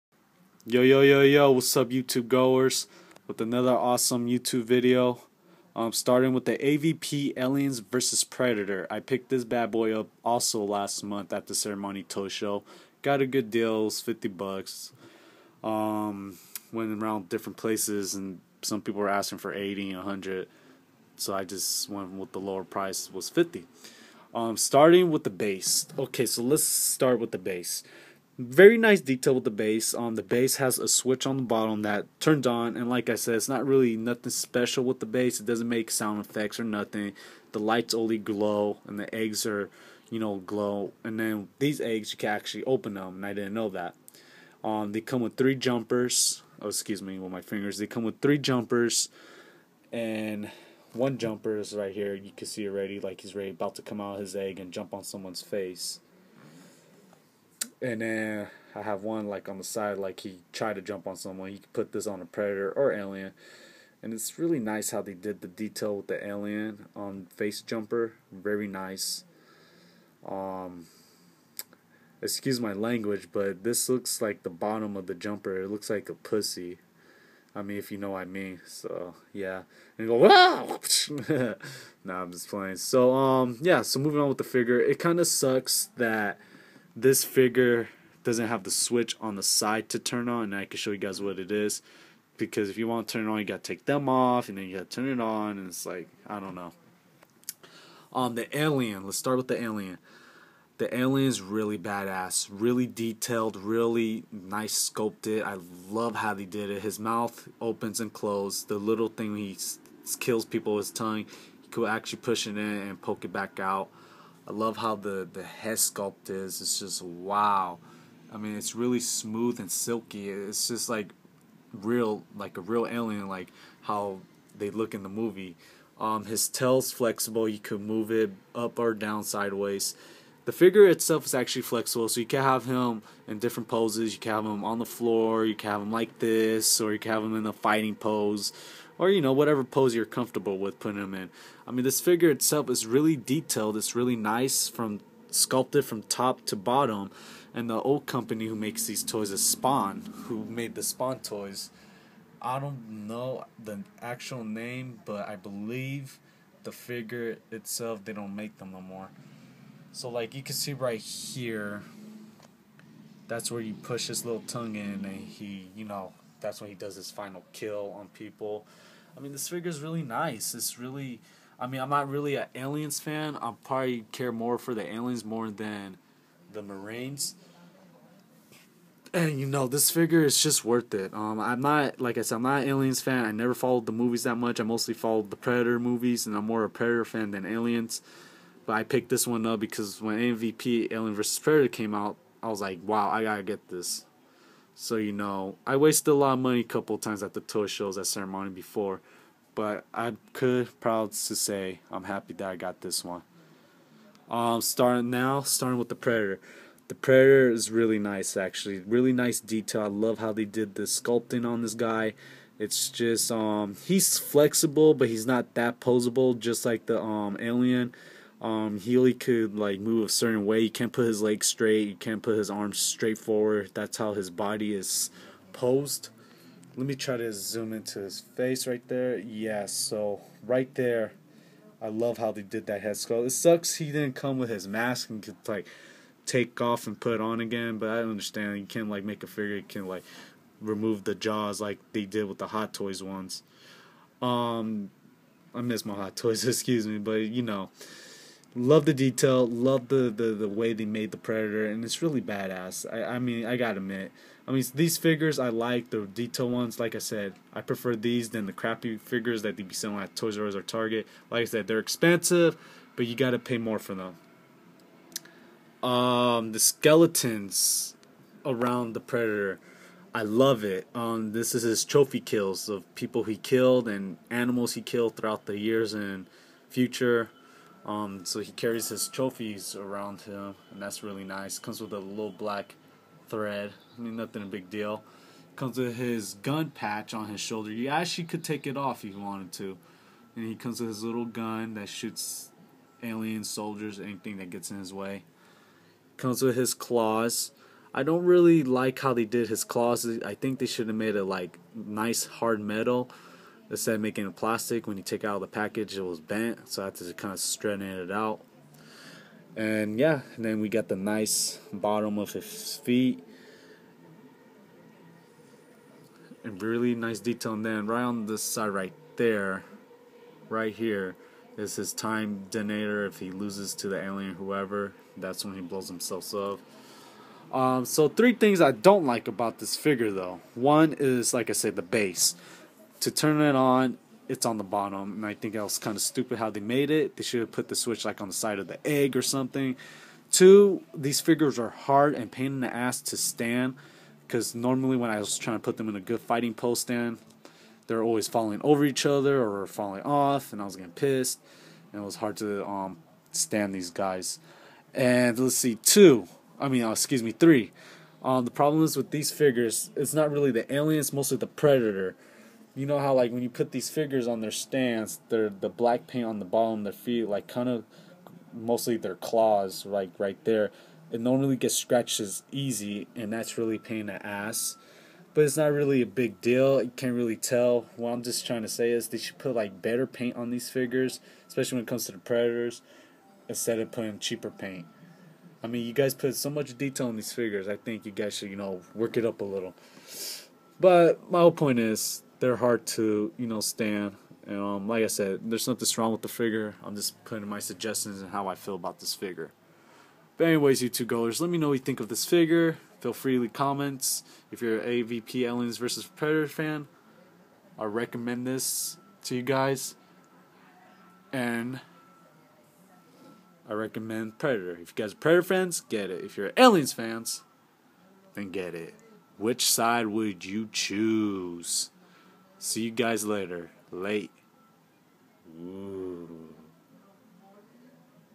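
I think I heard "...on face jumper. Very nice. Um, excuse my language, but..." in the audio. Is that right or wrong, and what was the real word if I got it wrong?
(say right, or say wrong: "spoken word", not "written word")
right.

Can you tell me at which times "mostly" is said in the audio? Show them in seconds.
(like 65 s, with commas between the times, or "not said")
184 s, 361 s, 368 s.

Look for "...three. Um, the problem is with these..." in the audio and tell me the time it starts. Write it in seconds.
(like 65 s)
357 s.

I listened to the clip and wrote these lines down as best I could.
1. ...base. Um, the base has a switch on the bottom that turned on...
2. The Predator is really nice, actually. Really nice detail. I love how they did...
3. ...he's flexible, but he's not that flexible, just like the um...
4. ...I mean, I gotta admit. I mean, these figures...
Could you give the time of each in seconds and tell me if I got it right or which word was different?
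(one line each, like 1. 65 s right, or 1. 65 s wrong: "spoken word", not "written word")
1. 29 s right
2. 206 s right
3. 213 s wrong: "posable", not "flexible"
4. 253 s right.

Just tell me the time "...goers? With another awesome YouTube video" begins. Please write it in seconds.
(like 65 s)
2 s.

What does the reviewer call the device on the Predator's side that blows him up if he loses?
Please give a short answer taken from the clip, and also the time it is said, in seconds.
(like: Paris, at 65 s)
time detonator, at 321 s.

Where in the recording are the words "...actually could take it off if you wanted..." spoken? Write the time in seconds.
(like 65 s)
287 s.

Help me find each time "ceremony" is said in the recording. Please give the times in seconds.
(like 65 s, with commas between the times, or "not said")
11 s, 198 s.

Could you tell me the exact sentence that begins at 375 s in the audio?
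But it's not really a big deal.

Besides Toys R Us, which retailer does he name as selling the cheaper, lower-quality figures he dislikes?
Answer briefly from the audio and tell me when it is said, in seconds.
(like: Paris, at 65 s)
Target, at 260 s.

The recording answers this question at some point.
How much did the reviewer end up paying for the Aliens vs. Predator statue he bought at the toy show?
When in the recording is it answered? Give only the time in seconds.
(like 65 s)
13 s.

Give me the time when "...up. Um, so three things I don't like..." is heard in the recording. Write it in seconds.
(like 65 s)
326 s.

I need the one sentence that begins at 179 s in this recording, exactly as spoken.
And you know, this figure is just worth it.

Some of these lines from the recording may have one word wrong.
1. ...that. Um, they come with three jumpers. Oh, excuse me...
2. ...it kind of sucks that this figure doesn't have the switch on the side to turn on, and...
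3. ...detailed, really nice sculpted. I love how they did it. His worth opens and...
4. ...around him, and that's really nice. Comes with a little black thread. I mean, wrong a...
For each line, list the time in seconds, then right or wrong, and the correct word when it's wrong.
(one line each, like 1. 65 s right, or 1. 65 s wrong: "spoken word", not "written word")
1. 43 s right
2. 84 s right
3. 102 s wrong: "mouth", not "worth"
4. 279 s wrong: "nothing", not "wrong".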